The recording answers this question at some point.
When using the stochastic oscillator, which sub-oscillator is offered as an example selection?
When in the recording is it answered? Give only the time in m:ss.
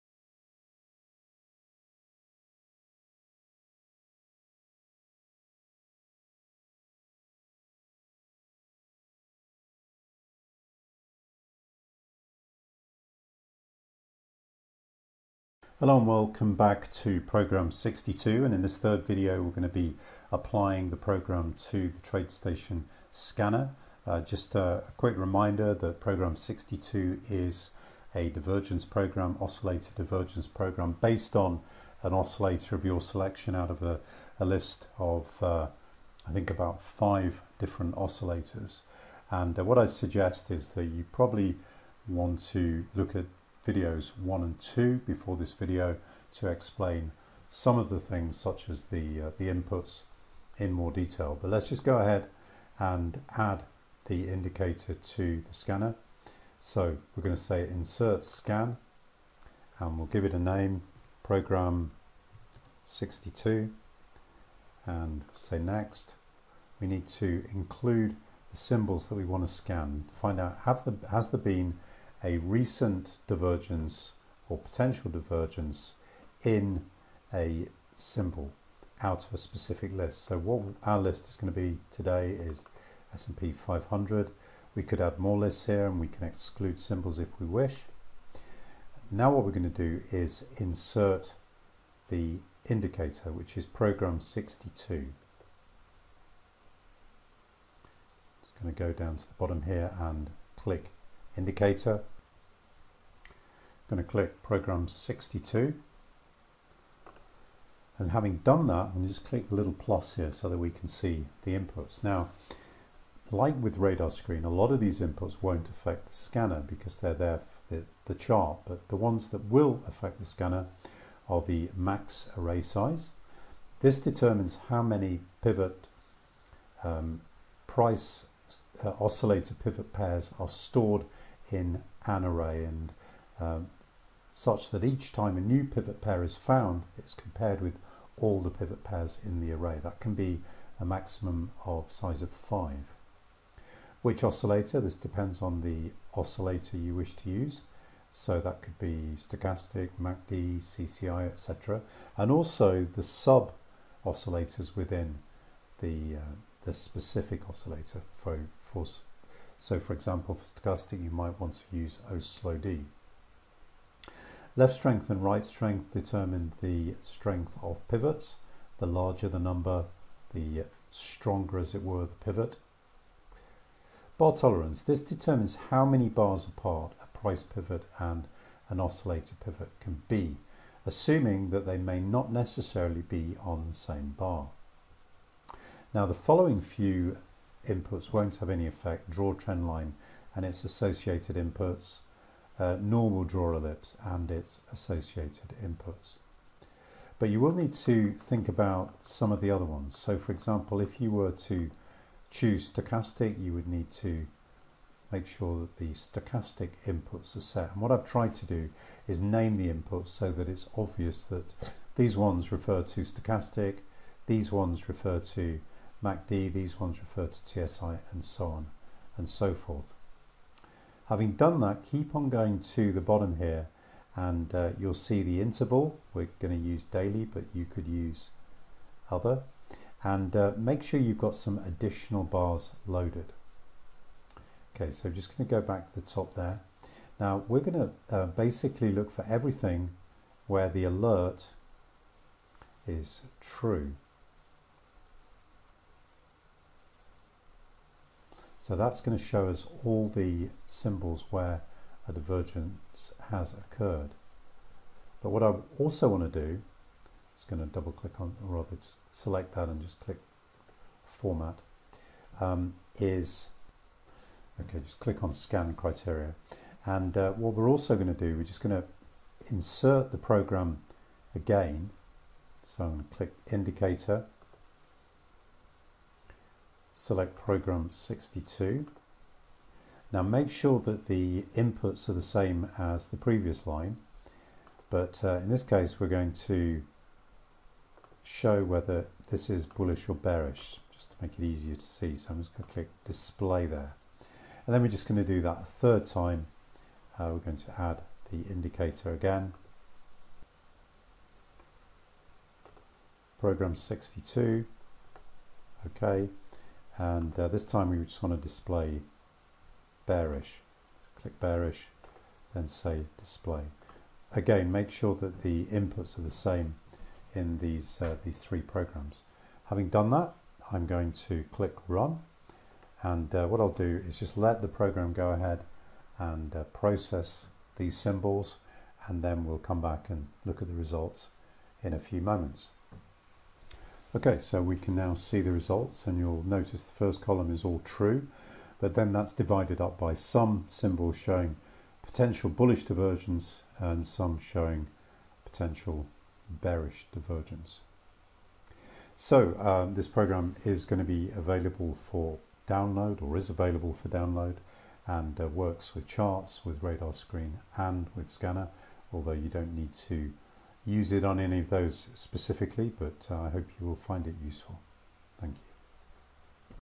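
2:42.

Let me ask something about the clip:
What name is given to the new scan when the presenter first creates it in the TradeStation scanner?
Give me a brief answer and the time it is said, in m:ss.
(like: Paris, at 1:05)
program 62, at 1:01.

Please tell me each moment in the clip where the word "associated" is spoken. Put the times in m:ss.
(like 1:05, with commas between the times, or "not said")
3:10, 3:14.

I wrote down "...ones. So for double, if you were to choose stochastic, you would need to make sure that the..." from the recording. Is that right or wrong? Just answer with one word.
wrong.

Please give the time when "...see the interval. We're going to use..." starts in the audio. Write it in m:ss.
3:44.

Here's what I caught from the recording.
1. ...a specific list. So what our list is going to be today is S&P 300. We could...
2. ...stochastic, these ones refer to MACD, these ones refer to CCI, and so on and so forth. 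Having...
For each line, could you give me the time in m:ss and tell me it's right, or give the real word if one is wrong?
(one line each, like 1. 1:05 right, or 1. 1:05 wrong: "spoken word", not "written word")
1. 1:19 wrong: "500", not "300"
2. 3:33 wrong: "TSI", not "CCI".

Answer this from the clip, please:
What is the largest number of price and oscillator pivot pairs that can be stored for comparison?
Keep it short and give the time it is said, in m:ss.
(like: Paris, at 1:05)
5, at 2:21.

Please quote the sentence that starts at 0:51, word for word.
But let's just go ahead and add the indicator to the scanner.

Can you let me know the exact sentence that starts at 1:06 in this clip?
We need to include the symbols that we want to scan.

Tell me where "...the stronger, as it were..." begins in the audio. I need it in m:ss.
2:50.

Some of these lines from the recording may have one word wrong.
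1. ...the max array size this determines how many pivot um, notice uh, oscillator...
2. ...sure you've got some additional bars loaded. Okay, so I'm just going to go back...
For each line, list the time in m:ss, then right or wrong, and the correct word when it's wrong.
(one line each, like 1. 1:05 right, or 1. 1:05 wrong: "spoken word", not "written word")
1. 2:01 wrong: "price", not "notice"
2. 3:50 right.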